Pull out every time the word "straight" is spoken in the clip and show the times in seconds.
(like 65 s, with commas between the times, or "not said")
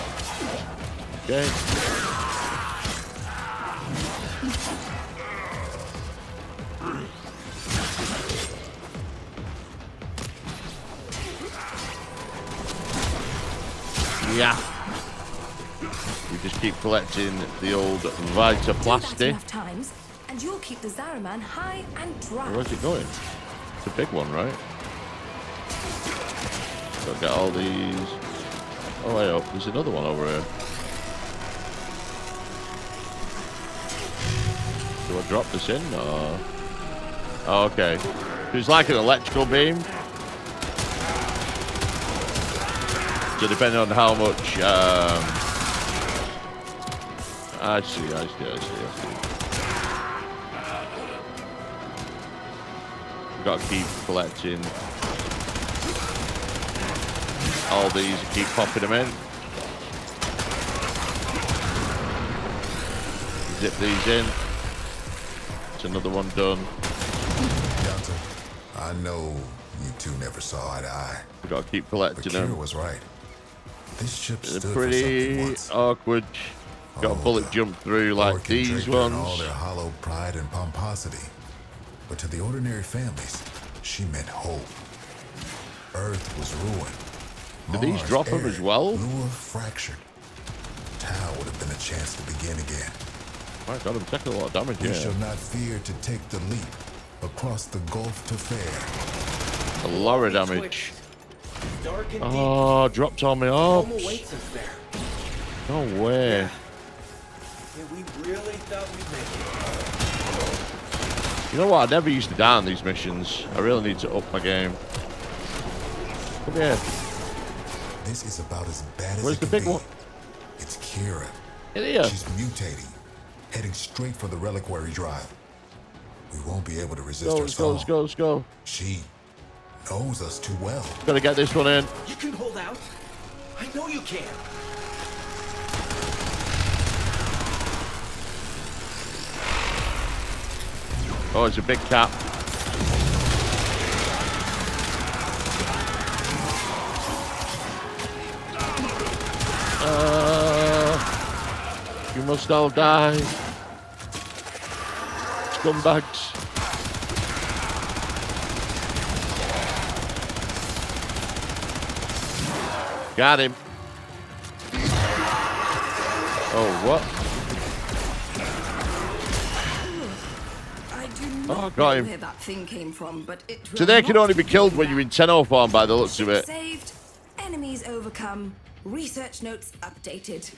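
123 s.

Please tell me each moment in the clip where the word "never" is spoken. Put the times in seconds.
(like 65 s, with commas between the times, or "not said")
70 s, 111 s.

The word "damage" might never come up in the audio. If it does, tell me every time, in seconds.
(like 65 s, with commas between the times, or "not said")
94 s, 100 s.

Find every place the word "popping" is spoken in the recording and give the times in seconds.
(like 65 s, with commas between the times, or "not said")
58 s.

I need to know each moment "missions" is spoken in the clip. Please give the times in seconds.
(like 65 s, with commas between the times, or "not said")
112 s.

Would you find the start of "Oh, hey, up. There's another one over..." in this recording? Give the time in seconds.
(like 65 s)
29 s.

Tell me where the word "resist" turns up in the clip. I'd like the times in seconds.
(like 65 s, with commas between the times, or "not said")
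127 s.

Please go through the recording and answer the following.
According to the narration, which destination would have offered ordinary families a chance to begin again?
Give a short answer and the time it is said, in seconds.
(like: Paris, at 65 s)
Tau, at 90 s.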